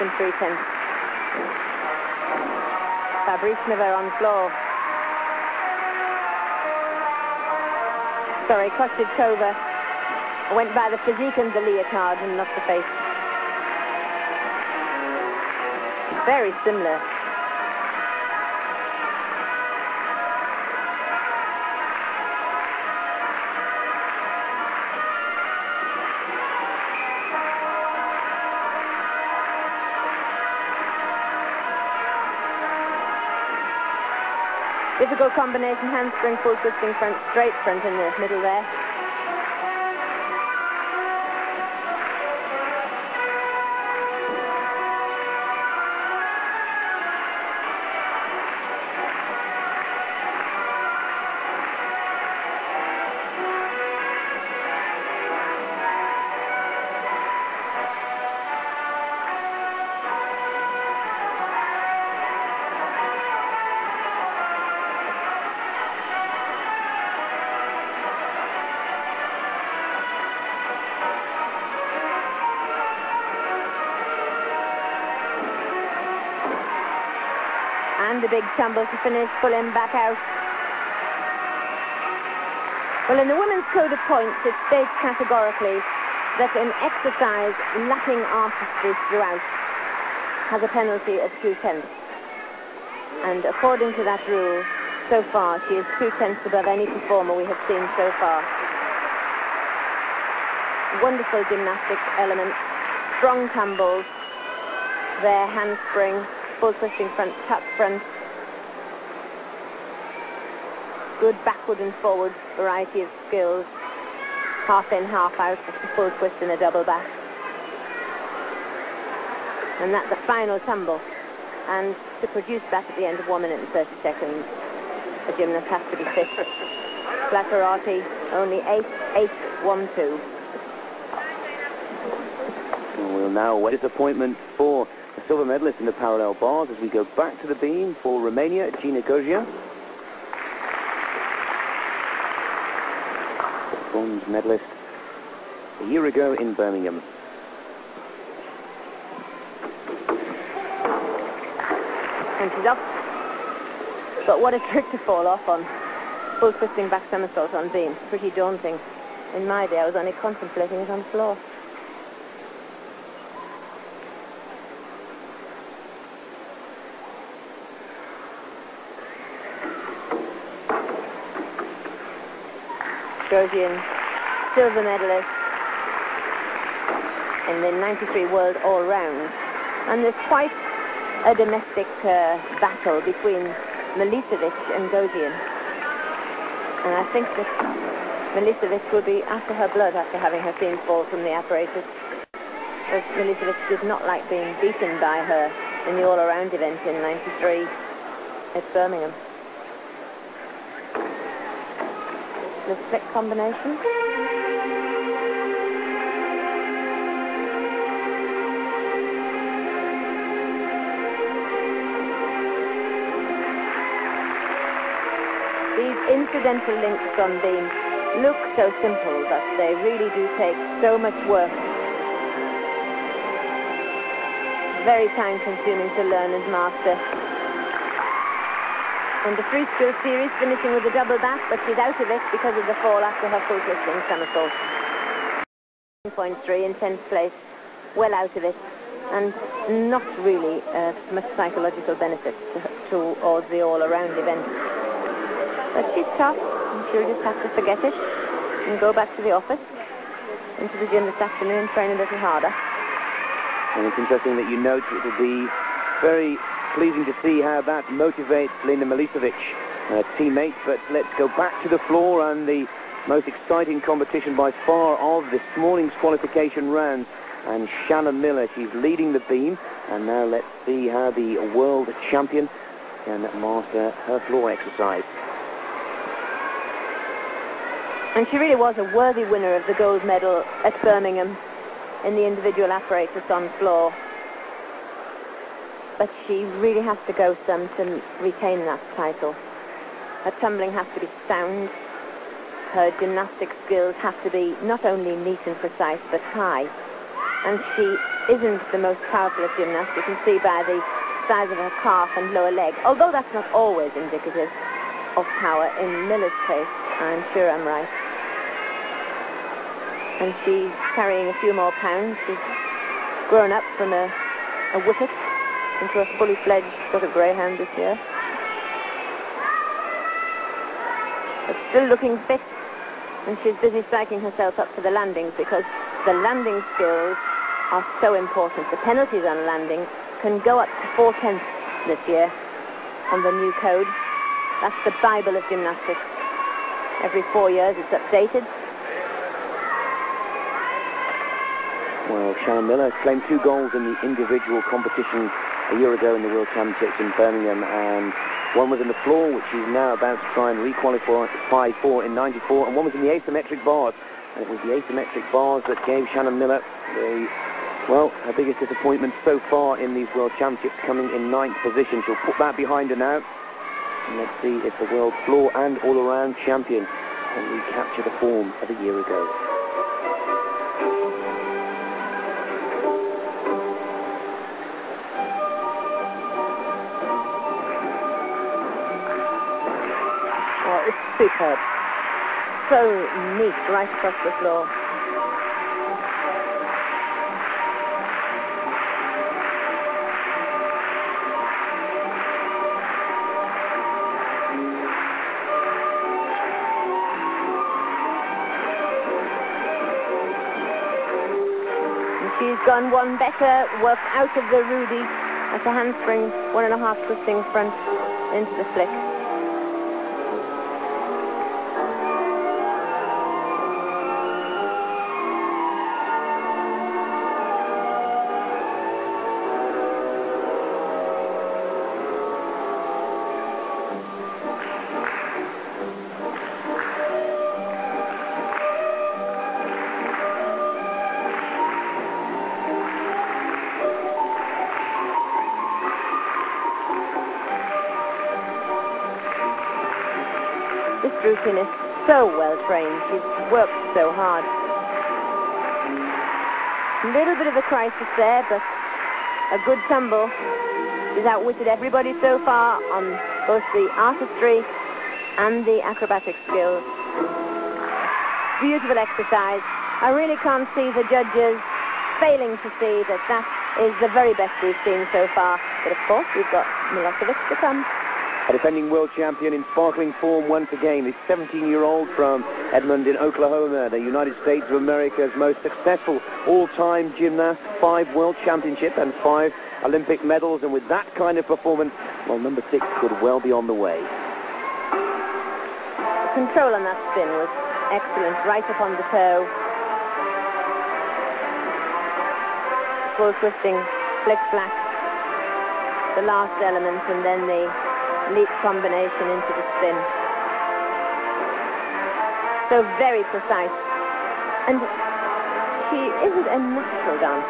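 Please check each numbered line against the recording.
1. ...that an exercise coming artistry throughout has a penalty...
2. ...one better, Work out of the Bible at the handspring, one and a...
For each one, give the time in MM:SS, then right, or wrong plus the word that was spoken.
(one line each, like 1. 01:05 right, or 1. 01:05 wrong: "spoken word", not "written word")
1. 01:26 wrong: "lacking", not "coming"
2. 06:42 wrong: "Rudy", not "Bible".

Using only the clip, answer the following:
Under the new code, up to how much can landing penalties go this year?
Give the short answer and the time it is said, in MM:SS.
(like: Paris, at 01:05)
four tenths, at 05:30.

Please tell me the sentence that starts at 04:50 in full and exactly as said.
Her tumbling has to be sound.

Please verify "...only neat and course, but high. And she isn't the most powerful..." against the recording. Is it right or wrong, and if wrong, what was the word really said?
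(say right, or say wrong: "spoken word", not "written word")
wrong: "precise", not "course".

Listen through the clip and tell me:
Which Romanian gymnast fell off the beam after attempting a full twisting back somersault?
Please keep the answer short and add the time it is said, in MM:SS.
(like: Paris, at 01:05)
Gina Gogean, at 02:18.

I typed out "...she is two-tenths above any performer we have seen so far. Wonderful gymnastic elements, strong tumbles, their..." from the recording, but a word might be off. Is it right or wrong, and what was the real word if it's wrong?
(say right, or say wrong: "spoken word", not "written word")
right.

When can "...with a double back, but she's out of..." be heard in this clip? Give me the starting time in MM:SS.
03:50.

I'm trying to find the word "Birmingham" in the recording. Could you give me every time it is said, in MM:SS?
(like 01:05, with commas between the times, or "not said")
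02:26, 03:18, 04:40, 05:47.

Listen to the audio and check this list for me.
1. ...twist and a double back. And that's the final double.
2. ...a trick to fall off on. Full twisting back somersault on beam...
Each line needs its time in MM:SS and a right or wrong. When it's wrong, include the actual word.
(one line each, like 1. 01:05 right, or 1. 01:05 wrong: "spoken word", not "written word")
1. 01:56 wrong: "tumble", not "double"
2. 02:34 right.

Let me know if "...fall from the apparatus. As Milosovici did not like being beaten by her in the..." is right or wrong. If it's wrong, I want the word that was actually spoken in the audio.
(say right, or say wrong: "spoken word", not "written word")
right.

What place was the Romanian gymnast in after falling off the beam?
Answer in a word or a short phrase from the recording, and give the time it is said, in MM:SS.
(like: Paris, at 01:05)
10th place, at 03:56.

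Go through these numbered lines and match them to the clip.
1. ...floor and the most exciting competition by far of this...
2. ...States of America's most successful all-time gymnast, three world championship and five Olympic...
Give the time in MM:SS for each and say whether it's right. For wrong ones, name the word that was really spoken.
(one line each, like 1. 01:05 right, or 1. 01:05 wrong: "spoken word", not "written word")
1. 04:21 right
2. 07:54 wrong: "five", not "three".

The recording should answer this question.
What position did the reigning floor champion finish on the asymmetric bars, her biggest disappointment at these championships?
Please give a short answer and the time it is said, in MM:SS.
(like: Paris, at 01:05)
ninth, at 06:01.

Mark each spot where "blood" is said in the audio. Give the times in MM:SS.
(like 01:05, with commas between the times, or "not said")
03:09.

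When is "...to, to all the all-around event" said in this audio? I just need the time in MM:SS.
04:02.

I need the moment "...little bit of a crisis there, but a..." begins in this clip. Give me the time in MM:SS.
07:27.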